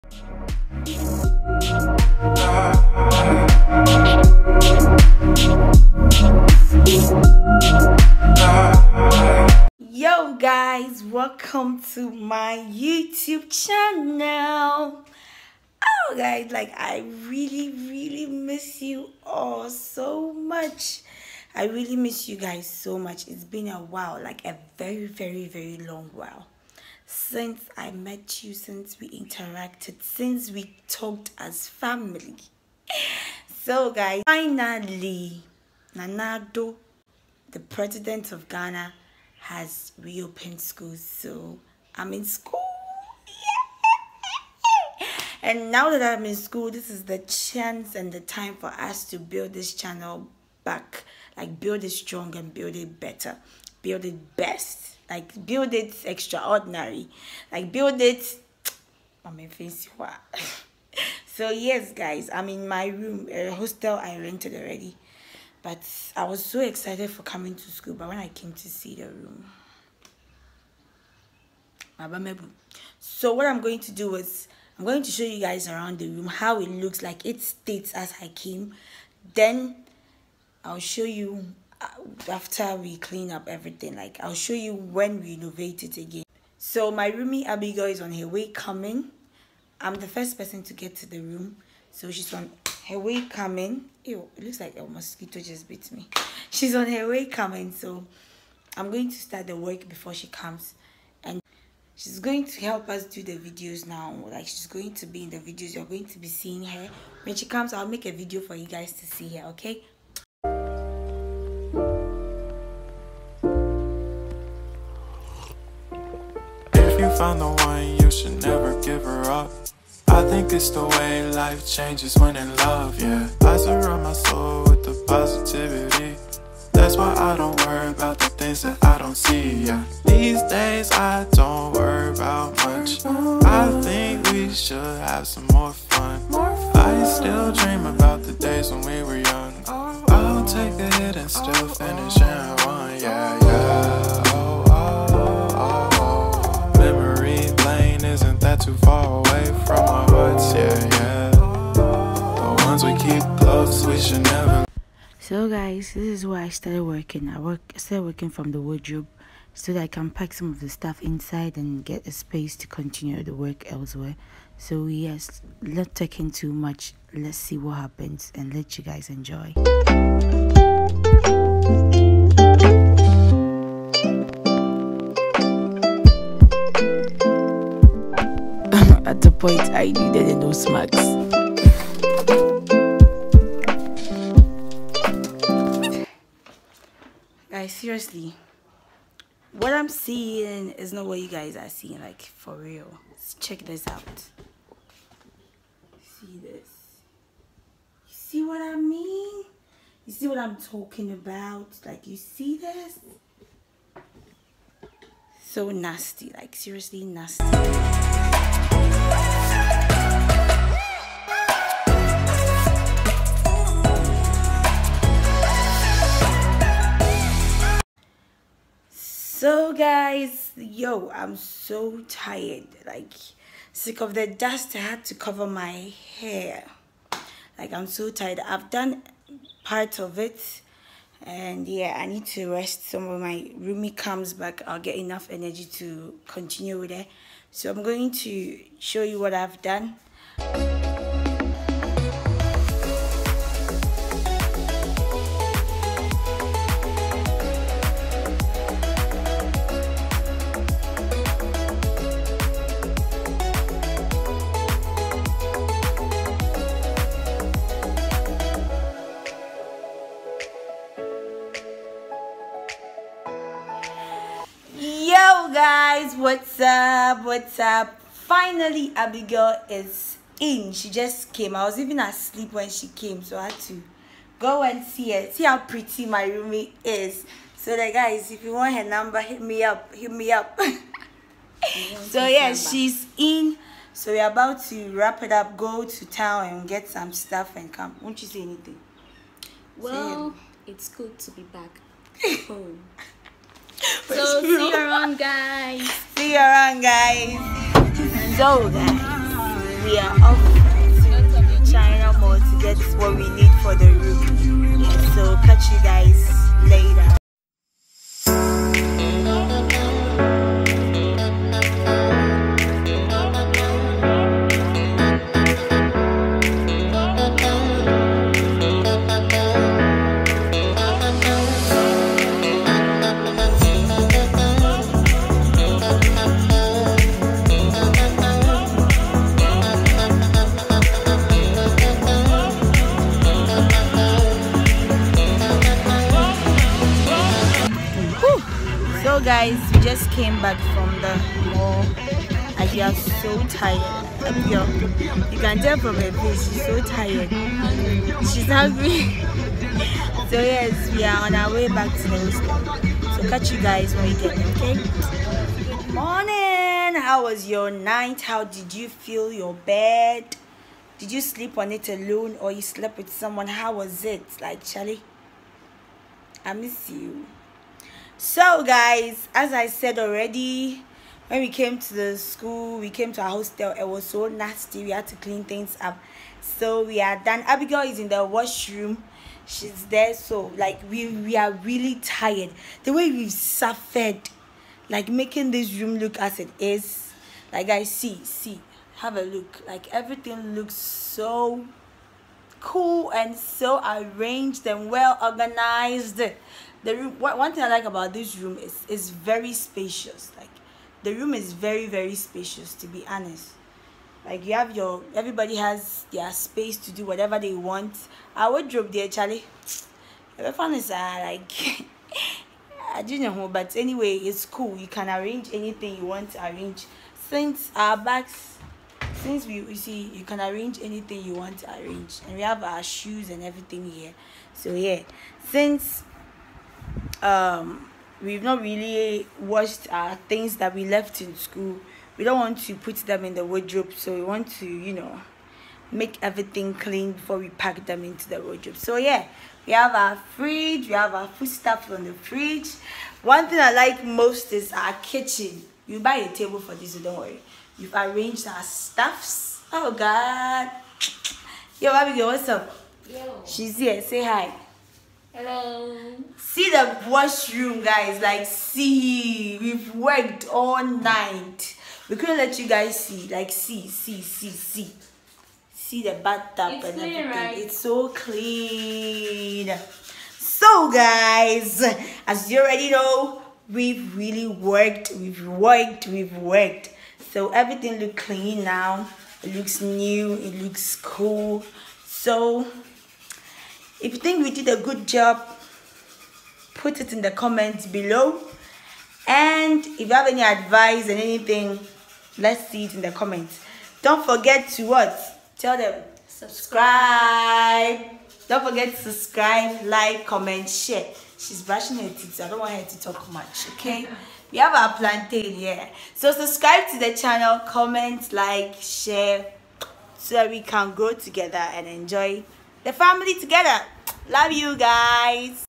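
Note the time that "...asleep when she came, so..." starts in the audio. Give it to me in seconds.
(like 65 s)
271 s.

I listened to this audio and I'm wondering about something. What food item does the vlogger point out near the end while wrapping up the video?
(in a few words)
plantain.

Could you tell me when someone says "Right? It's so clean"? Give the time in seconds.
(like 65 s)
467 s.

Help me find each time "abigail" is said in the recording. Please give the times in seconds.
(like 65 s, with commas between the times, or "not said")
87 s, 268 s, 377 s, 451 s.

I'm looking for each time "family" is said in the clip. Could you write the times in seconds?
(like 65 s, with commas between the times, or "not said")
31 s, 512 s.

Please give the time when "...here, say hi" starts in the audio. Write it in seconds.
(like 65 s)
453 s.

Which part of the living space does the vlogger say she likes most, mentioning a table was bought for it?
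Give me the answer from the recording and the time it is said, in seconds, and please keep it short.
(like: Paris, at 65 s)
kitchen, at 445 s.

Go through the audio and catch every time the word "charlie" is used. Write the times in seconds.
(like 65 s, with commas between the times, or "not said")
364 s, 409 s.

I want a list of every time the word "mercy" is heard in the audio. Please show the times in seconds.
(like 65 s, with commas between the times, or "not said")
not said.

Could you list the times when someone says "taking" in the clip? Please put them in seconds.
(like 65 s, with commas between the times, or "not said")
165 s.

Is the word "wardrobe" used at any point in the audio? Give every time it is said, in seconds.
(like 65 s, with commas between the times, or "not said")
158 s, 408 s, 433 s, 438 s.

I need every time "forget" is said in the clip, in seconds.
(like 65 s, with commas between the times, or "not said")
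494 s, 498 s.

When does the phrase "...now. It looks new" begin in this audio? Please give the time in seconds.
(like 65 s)
478 s.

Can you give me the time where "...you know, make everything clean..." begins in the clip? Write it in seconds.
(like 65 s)
434 s.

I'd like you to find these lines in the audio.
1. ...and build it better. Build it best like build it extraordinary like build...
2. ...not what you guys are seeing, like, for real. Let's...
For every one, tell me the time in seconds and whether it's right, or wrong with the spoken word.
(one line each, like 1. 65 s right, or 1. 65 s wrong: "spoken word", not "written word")
1. 52 s right
2. 190 s right.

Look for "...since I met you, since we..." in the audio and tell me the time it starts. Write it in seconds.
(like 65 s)
27 s.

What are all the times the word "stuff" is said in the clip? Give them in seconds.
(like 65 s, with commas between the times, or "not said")
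160 s, 287 s, 441 s, 448 s.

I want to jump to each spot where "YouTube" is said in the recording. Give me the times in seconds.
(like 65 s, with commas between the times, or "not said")
12 s.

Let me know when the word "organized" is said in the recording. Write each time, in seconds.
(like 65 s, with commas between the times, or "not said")
395 s.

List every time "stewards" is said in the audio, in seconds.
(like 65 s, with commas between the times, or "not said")
not said.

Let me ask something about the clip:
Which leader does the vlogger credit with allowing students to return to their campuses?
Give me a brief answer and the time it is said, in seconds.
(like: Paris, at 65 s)
Nana Addo, at 35 s.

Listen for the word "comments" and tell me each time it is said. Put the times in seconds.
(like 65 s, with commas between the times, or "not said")
487 s, 493 s, 500 s, 507 s.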